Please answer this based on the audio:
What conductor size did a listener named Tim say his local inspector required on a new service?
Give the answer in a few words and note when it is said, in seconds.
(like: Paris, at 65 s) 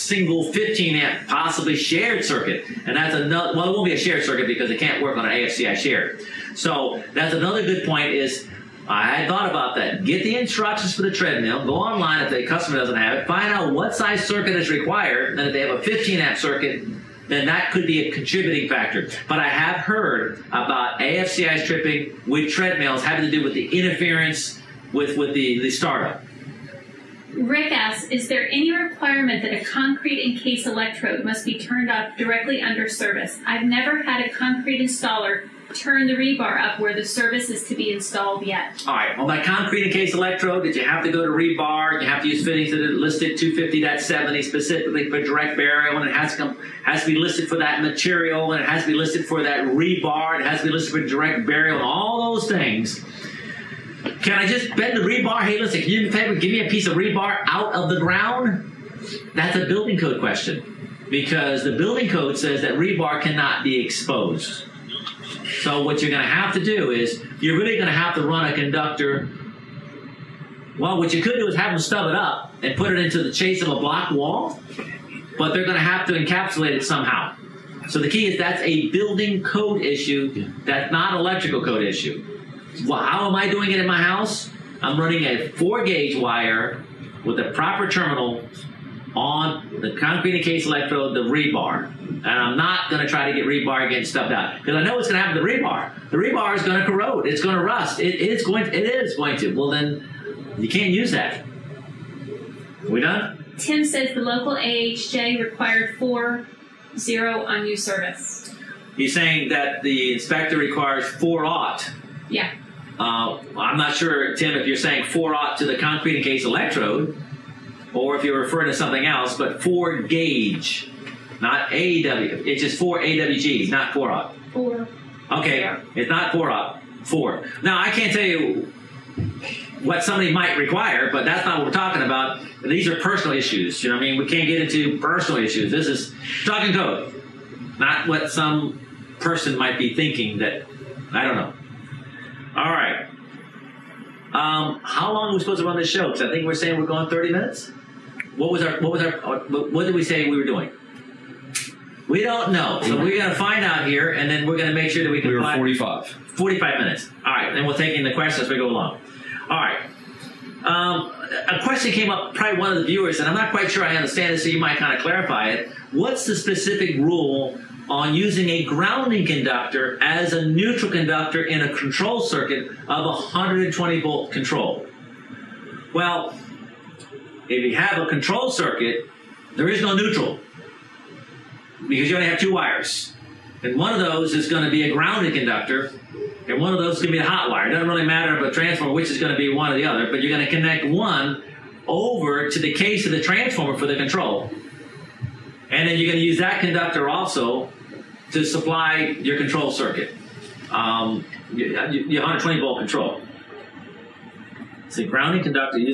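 4/0, at 105 s.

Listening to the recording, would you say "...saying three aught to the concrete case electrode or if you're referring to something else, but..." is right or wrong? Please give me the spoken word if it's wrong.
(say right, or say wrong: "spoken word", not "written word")
wrong: "four", not "three".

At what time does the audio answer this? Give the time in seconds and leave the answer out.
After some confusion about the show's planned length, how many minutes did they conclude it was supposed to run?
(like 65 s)
156 s.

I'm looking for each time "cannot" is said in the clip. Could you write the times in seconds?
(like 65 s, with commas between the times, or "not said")
63 s.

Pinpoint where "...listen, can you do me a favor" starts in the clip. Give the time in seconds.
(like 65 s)
55 s.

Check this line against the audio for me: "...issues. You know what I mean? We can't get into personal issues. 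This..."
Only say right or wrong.
right.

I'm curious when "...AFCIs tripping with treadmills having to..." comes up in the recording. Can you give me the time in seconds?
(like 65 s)
20 s.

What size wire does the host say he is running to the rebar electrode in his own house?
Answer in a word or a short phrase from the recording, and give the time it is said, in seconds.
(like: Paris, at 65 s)
4 gauge, at 85 s.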